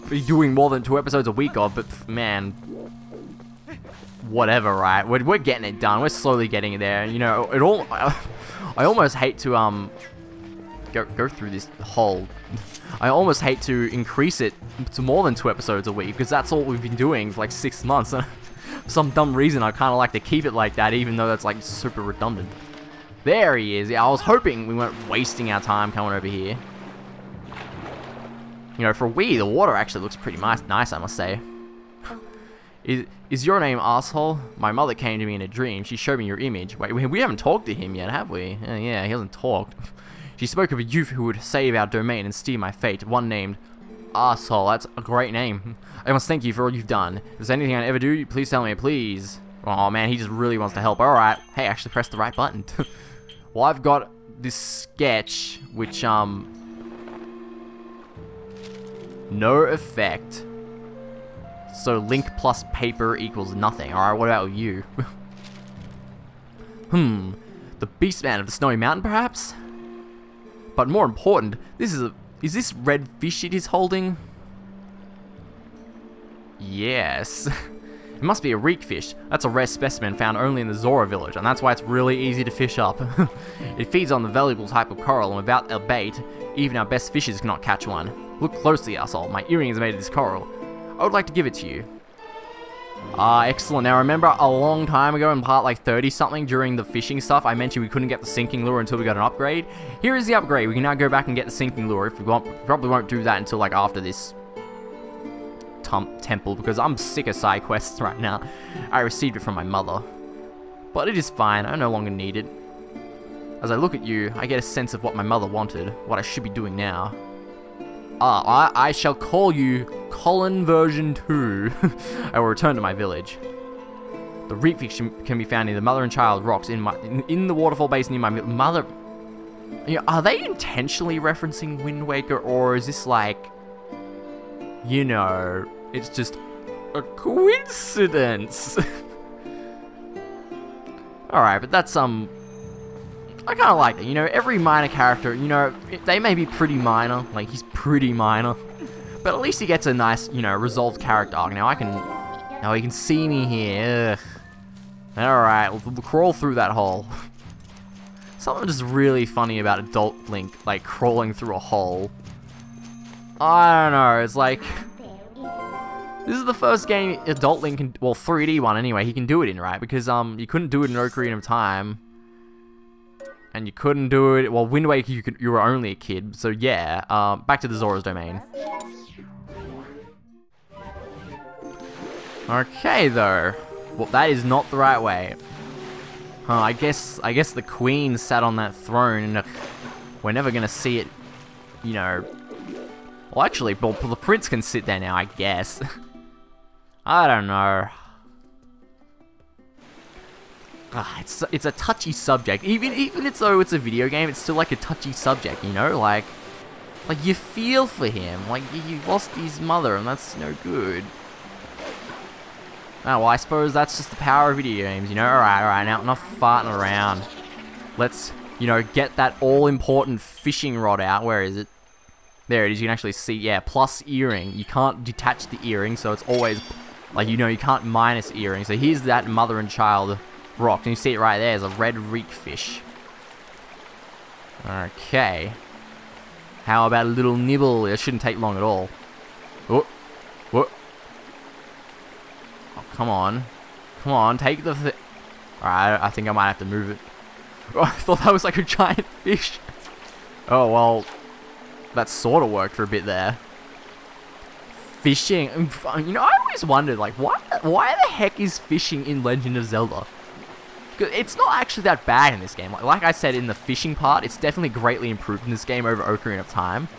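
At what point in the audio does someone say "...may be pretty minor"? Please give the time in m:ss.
2:26.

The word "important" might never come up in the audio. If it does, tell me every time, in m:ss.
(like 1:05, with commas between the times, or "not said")
1:11, 3:39.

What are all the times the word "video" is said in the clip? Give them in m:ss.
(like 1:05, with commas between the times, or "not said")
3:23, 3:34.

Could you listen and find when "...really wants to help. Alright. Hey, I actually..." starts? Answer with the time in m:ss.
0:50.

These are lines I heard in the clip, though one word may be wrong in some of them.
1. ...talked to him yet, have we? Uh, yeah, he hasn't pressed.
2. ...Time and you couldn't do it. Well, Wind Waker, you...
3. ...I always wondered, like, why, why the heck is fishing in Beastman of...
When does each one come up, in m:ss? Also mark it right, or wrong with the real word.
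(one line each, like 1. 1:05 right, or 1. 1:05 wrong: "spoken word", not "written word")
1. 0:37 wrong: "talked", not "pressed"
2. 2:51 right
3. 4:16 wrong: "Legend", not "Beastman".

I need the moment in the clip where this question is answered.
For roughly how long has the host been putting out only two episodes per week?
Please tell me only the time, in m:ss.
0:17.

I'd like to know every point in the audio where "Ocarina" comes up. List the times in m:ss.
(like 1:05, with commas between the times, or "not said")
2:50, 4:26.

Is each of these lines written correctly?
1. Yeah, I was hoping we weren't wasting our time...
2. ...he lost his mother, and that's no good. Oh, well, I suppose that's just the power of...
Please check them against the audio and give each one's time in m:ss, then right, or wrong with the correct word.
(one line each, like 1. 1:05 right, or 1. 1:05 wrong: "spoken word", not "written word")
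1. 0:23 right
2. 3:28 right.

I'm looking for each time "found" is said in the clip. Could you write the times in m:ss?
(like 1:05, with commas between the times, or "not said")
1:20, 2:05.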